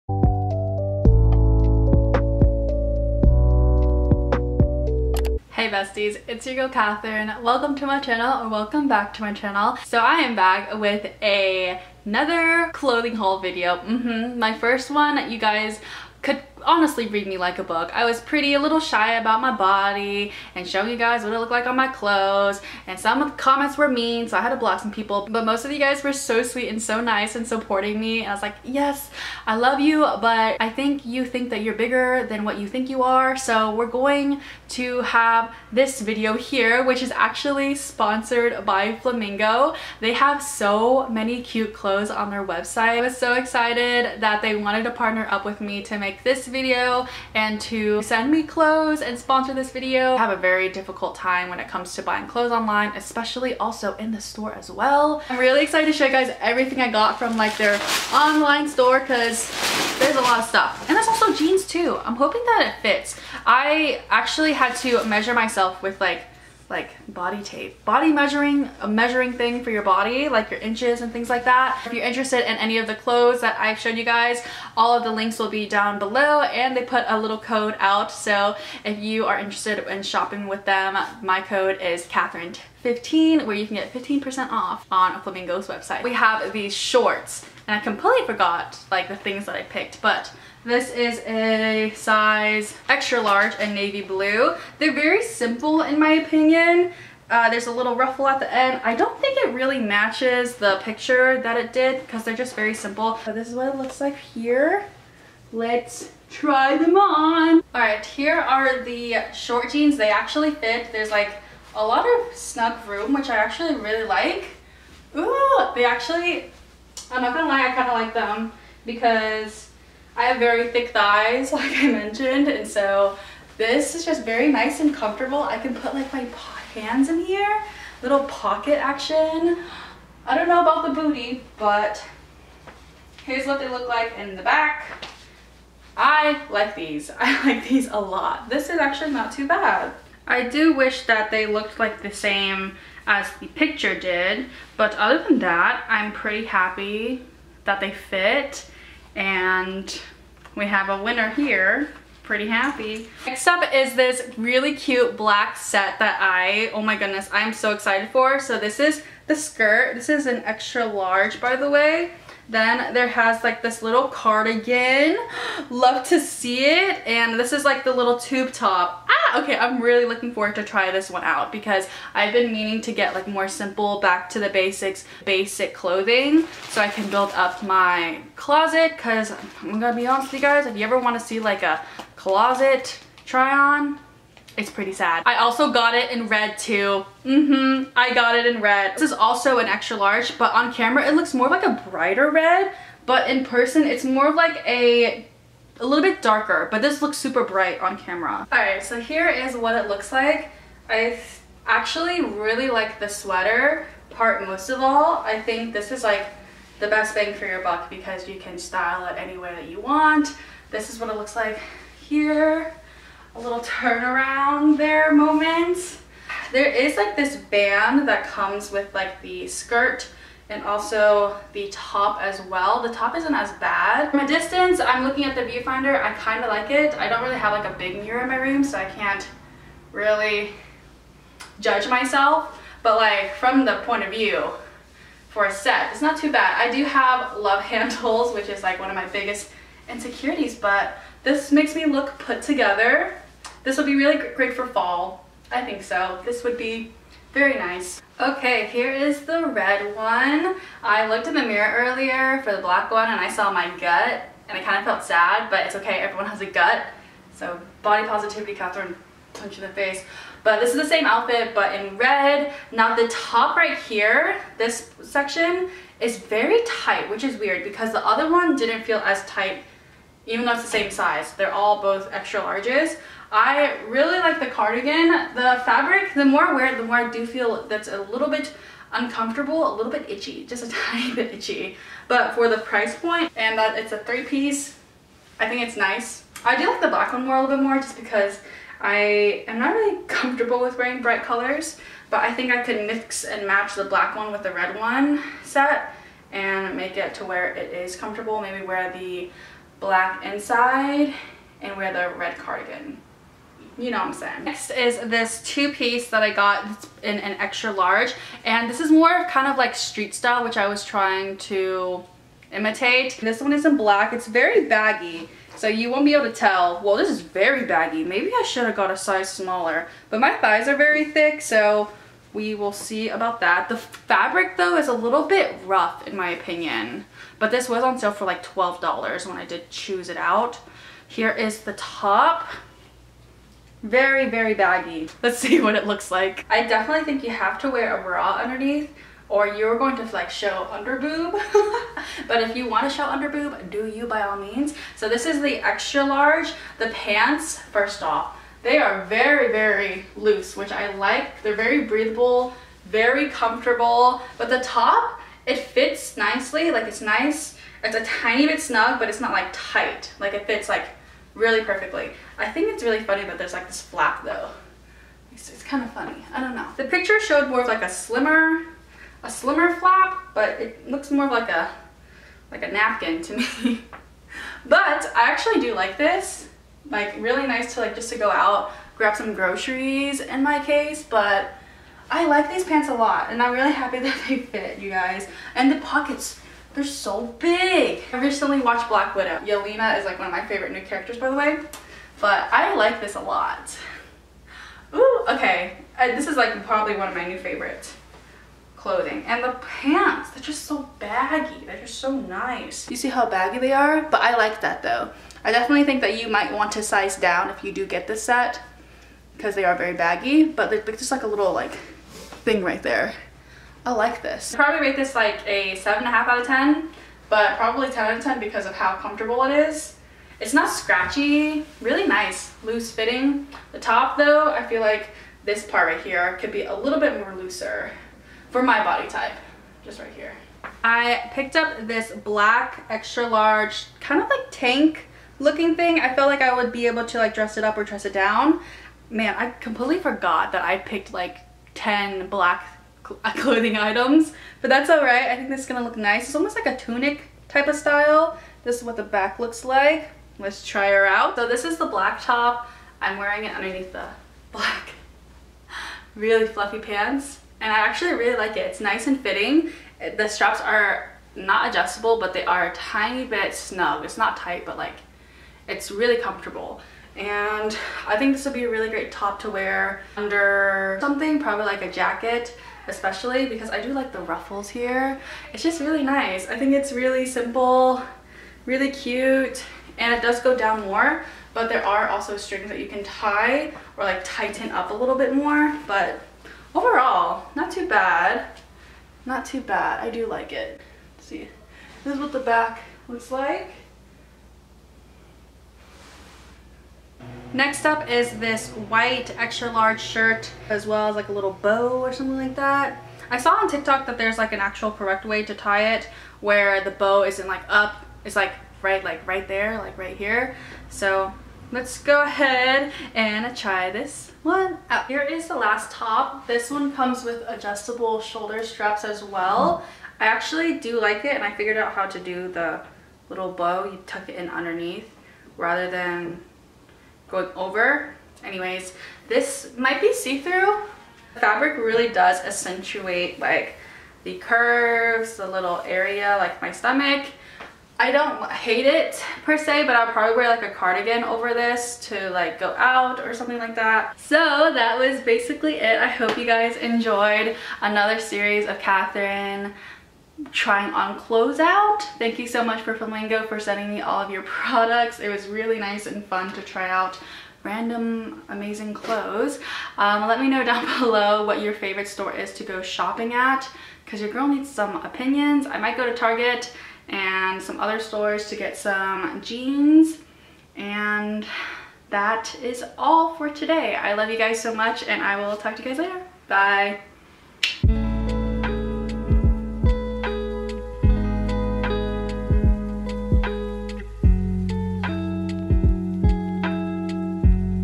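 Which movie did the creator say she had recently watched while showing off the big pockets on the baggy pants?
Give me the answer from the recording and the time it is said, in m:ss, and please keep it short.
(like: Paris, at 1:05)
Black Widow, at 6:28.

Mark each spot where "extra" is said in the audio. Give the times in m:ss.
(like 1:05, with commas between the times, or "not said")
1:32, 2:40, 3:09, 4:32, 5:07, 5:45, 7:12, 8:19.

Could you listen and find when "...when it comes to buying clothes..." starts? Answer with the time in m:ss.
0:51.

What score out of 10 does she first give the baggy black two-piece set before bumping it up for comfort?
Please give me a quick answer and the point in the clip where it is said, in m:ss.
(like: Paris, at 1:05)
7.5, at 6:55.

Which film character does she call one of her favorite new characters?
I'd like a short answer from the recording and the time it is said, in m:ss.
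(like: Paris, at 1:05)
Yelena, at 6:29.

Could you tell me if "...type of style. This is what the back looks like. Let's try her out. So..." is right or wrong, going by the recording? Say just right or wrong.
right.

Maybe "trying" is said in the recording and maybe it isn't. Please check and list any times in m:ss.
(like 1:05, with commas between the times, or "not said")
5:10, 9:10.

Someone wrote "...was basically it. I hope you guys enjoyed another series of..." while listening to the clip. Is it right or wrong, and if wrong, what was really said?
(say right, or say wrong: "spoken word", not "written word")
right.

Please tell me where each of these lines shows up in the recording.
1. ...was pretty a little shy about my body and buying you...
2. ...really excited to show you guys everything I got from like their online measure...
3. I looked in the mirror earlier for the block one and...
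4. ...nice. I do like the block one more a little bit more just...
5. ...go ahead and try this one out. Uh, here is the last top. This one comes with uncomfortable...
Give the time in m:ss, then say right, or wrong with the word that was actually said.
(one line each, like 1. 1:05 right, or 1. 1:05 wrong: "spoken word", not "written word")
1. 0:18 wrong: "showing", not "buying"
2. 0:55 wrong: "store", not "measure"
3. 4:10 wrong: "black", not "block"
4. 4:45 wrong: "black", not "block"
5. 8:32 wrong: "adjustable", not "uncomfortable".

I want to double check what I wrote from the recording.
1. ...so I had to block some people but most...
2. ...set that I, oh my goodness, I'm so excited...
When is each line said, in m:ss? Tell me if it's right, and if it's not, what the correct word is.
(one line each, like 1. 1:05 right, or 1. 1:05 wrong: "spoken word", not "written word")
1. 0:24 right
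2. 2:35 right.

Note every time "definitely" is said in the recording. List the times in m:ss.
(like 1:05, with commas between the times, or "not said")
5:36, 6:45.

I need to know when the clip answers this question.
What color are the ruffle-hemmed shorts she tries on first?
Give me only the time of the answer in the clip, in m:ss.
1:33.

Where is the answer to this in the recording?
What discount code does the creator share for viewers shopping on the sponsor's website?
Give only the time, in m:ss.
1:22.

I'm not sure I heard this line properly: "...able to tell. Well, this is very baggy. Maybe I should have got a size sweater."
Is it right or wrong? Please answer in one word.
wrong.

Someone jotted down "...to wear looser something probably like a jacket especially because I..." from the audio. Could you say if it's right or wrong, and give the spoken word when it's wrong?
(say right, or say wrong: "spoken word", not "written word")
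wrong: "under", not "looser".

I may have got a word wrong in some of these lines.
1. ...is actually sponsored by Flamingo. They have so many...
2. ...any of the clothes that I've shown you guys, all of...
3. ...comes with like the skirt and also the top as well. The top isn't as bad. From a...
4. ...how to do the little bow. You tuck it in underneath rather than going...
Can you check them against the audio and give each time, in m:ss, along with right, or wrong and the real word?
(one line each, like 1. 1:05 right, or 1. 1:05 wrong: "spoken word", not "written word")
1. 0:37 right
2. 1:12 right
3. 3:38 right
4. 8:41 right.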